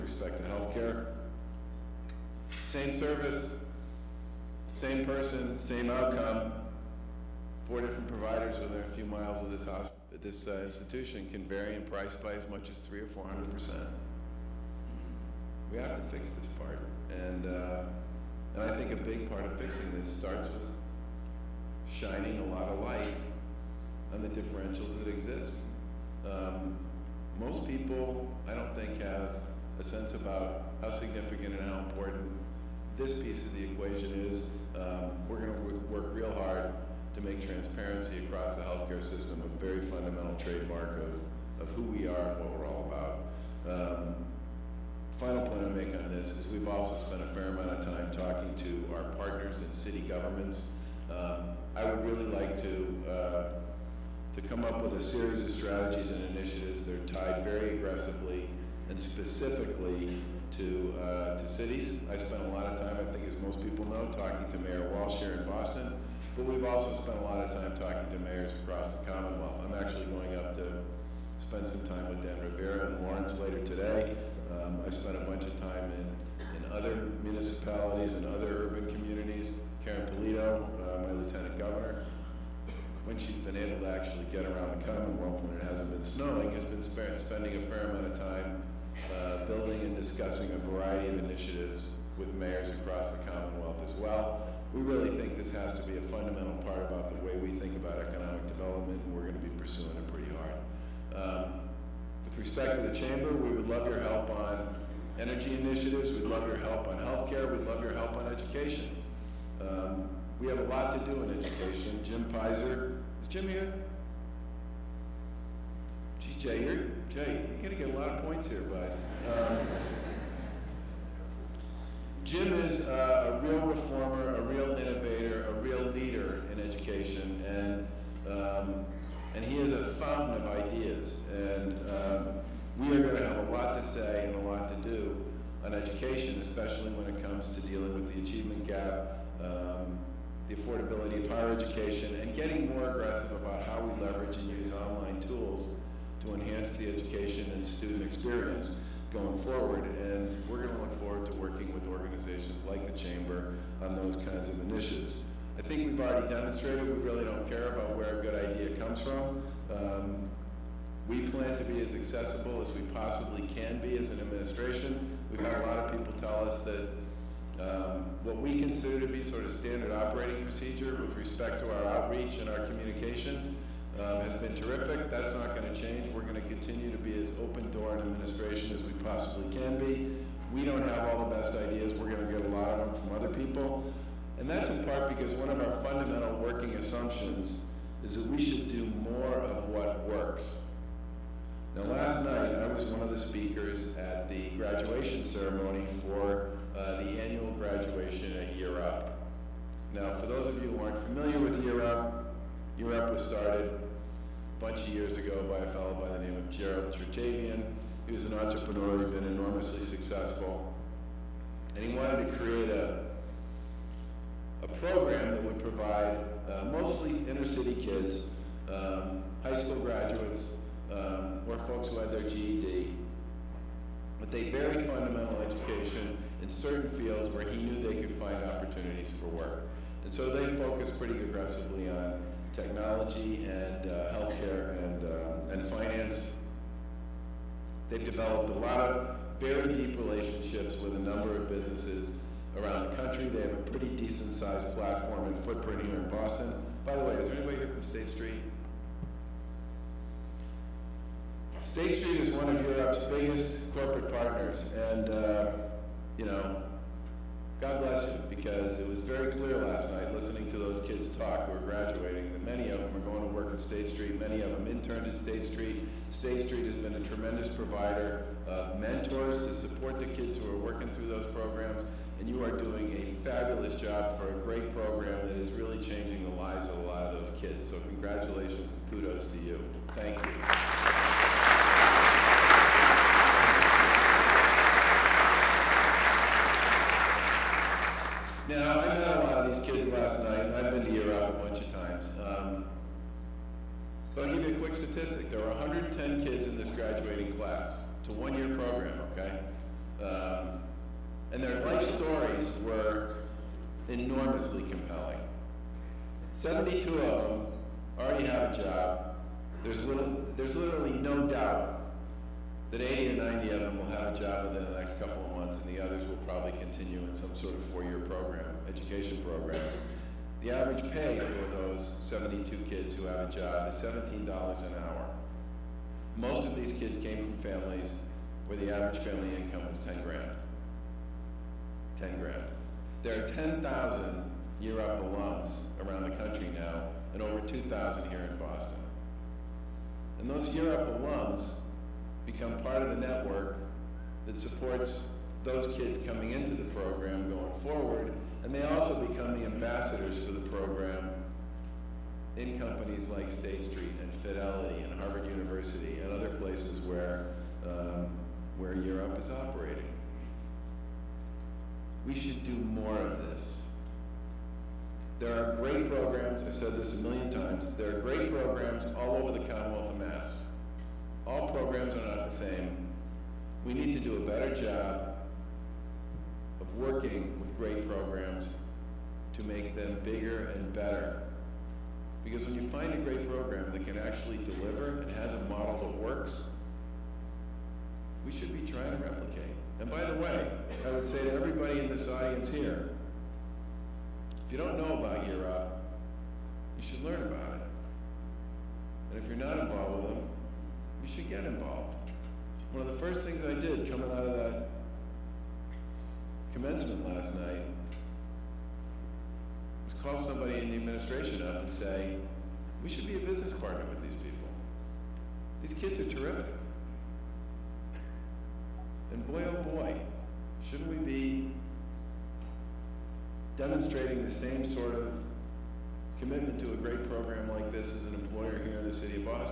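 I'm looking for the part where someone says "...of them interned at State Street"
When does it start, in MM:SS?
04:24.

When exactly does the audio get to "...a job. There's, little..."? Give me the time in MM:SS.
05:08.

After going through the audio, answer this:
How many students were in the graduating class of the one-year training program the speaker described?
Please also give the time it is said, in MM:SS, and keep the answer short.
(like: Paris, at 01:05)
110, at 04:55.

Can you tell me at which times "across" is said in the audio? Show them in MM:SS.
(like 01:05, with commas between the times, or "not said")
00:38, 01:08, 01:32.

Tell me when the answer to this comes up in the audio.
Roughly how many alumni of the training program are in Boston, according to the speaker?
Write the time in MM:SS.
05:37.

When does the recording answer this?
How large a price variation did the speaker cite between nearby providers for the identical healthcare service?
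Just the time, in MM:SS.
00:12.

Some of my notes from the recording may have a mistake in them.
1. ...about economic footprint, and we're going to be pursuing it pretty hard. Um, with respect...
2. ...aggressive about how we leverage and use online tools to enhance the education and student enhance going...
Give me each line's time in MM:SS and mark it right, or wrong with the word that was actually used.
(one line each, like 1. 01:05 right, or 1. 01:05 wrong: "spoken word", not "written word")
1. 01:37 wrong: "development", not "footprint"
2. 02:22 wrong: "experience", not "enhance".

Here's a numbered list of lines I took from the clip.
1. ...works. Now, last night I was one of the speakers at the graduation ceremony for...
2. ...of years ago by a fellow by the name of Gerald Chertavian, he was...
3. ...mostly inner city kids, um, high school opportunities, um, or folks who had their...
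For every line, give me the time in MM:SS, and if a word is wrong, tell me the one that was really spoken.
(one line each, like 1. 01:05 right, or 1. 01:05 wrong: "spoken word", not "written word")
1. 03:10 right
2. 03:24 right
3. 03:36 wrong: "graduates", not "opportunities".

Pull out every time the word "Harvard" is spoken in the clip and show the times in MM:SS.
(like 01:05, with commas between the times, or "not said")
05:55.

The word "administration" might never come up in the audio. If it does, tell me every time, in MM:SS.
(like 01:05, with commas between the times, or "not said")
02:44, 02:58, 06:50.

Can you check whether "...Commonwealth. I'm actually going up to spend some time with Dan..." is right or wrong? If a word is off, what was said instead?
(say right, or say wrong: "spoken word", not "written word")
right.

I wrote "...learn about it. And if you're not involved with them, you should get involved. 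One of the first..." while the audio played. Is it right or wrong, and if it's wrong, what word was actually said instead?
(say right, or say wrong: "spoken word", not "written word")
right.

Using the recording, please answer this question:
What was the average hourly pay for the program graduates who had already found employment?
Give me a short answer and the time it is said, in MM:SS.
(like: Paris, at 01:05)
$17 an hour, at 05:23.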